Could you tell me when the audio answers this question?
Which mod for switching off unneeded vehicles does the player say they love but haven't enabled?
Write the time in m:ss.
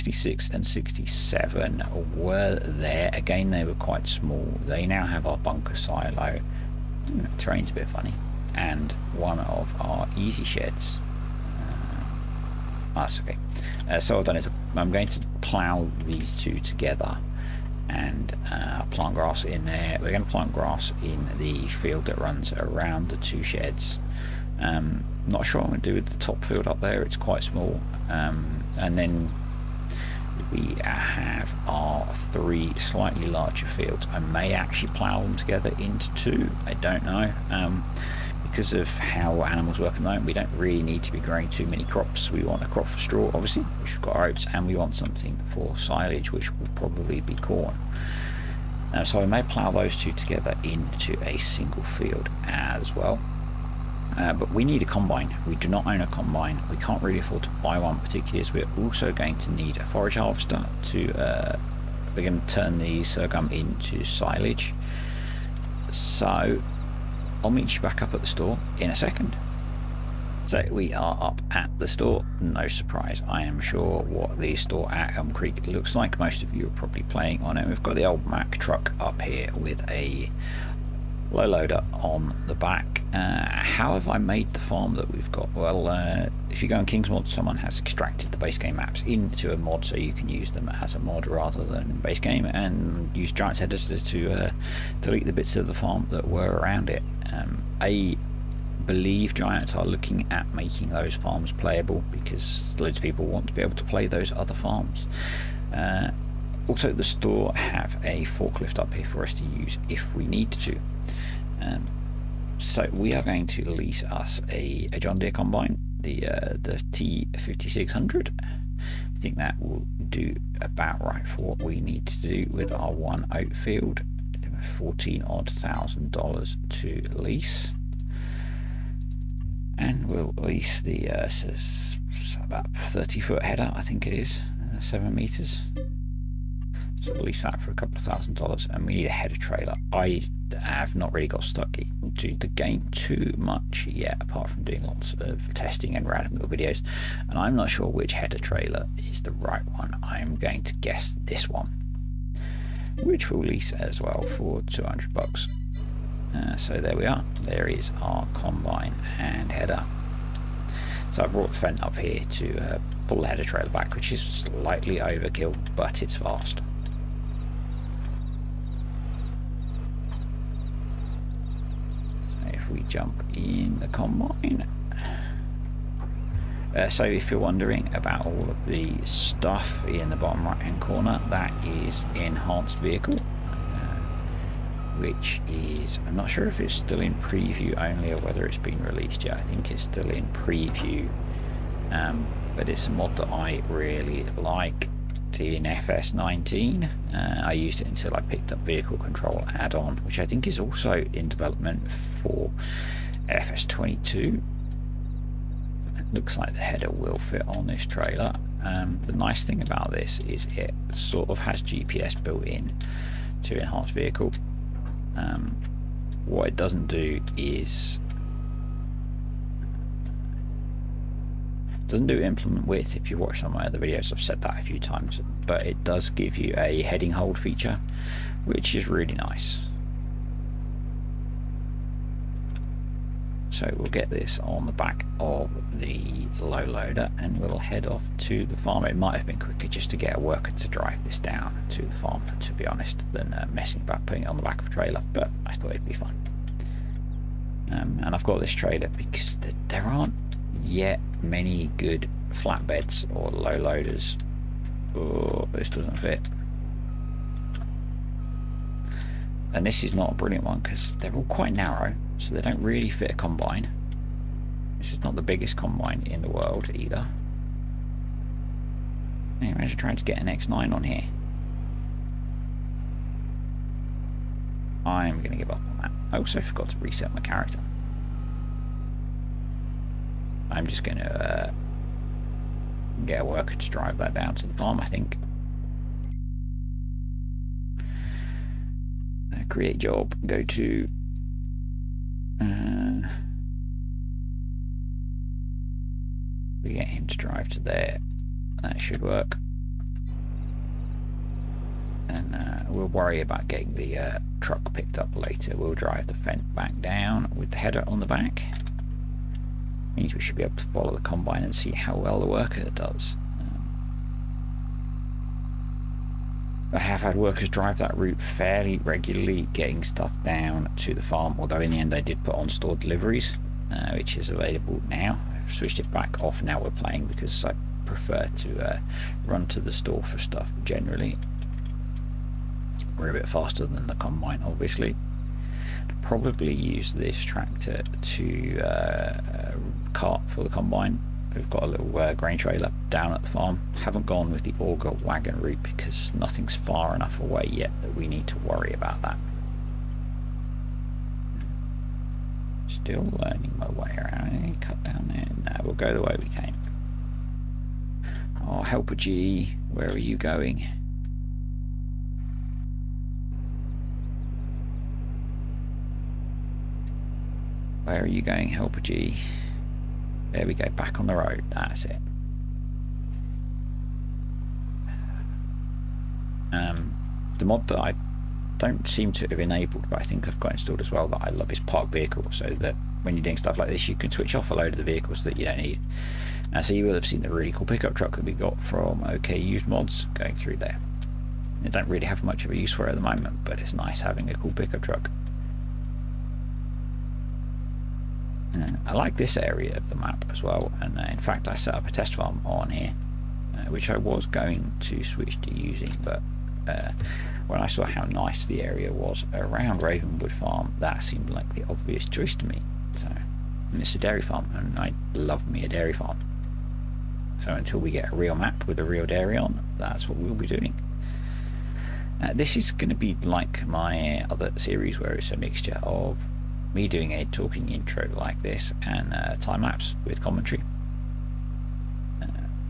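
6:21.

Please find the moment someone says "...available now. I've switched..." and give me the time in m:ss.
5:24.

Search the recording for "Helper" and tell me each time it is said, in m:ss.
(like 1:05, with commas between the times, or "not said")
5:58, 6:08.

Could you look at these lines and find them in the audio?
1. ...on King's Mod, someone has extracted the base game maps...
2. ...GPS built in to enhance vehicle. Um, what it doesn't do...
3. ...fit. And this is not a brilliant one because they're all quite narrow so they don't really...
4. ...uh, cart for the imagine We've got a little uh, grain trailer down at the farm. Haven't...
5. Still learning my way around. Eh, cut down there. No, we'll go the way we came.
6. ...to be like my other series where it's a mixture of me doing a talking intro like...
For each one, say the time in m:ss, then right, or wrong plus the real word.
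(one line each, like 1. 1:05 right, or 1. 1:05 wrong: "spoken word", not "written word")
1. 1:26 right
2. 3:31 right
3. 4:15 right
4. 5:38 wrong: "combine", not "imagine"
5. 5:52 right
6. 7:02 right.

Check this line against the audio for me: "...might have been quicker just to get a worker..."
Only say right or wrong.
right.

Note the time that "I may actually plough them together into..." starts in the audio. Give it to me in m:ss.
0:34.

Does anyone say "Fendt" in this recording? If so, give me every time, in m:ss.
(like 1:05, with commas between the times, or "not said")
2:41, 5:06.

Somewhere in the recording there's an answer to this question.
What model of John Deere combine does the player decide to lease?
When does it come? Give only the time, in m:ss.
1:56.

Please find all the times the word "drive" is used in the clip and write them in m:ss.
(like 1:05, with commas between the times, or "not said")
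4:00, 4:43, 4:57, 5:05, 5:17.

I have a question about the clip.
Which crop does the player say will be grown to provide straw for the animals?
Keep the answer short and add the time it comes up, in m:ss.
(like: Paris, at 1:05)
Oats, at 0:44.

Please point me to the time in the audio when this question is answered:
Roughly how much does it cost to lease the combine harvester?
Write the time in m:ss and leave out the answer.
2:04.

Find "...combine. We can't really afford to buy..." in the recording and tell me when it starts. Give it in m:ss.
0:56.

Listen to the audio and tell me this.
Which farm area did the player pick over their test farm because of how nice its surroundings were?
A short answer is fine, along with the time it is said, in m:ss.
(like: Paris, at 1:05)
Ravenwood Farm, at 6:49.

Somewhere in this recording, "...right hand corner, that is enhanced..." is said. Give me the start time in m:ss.
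3:00.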